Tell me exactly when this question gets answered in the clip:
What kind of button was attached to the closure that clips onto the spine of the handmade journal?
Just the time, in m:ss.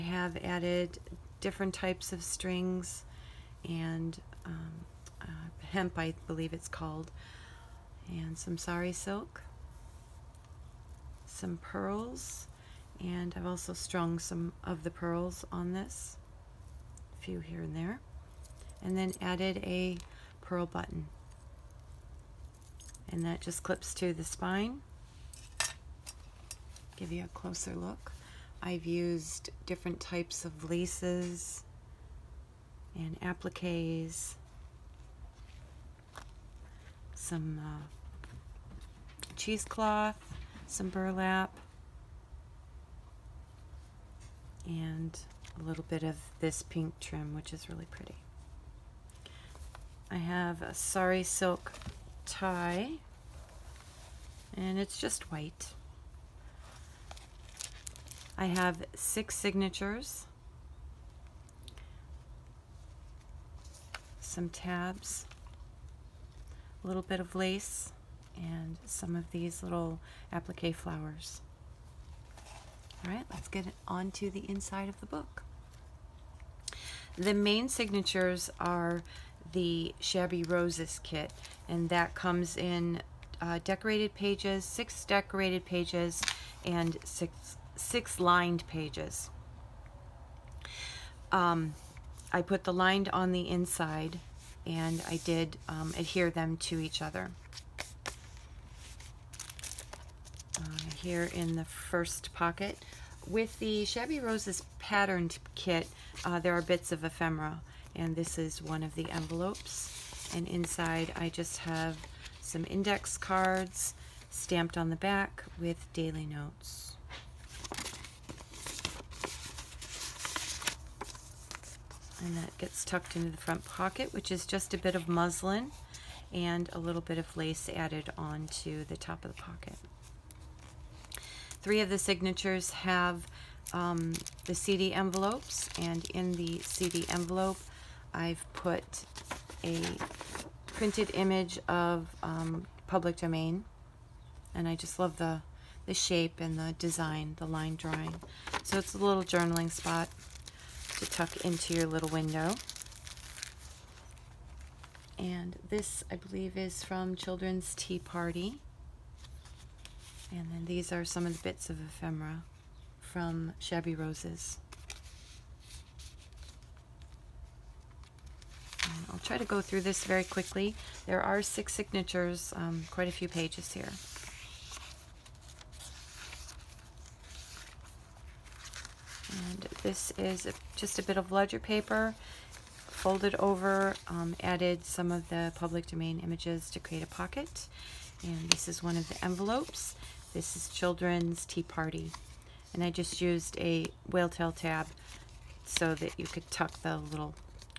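0:20.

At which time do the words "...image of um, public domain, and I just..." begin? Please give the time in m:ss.
2:21.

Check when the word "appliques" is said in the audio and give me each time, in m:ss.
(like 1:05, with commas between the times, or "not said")
0:33, 1:10.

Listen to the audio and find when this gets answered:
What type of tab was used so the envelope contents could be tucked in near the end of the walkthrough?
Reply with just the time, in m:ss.
3:14.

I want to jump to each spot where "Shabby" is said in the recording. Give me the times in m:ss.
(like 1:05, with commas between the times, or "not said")
1:19, 1:43, 2:43.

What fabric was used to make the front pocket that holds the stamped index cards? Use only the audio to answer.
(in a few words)
Muslin.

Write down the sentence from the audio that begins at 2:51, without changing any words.
There are six signatures, um, quite a few pages here.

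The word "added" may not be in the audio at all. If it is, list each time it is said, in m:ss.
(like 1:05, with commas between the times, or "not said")
0:00, 0:19, 2:07, 3:04.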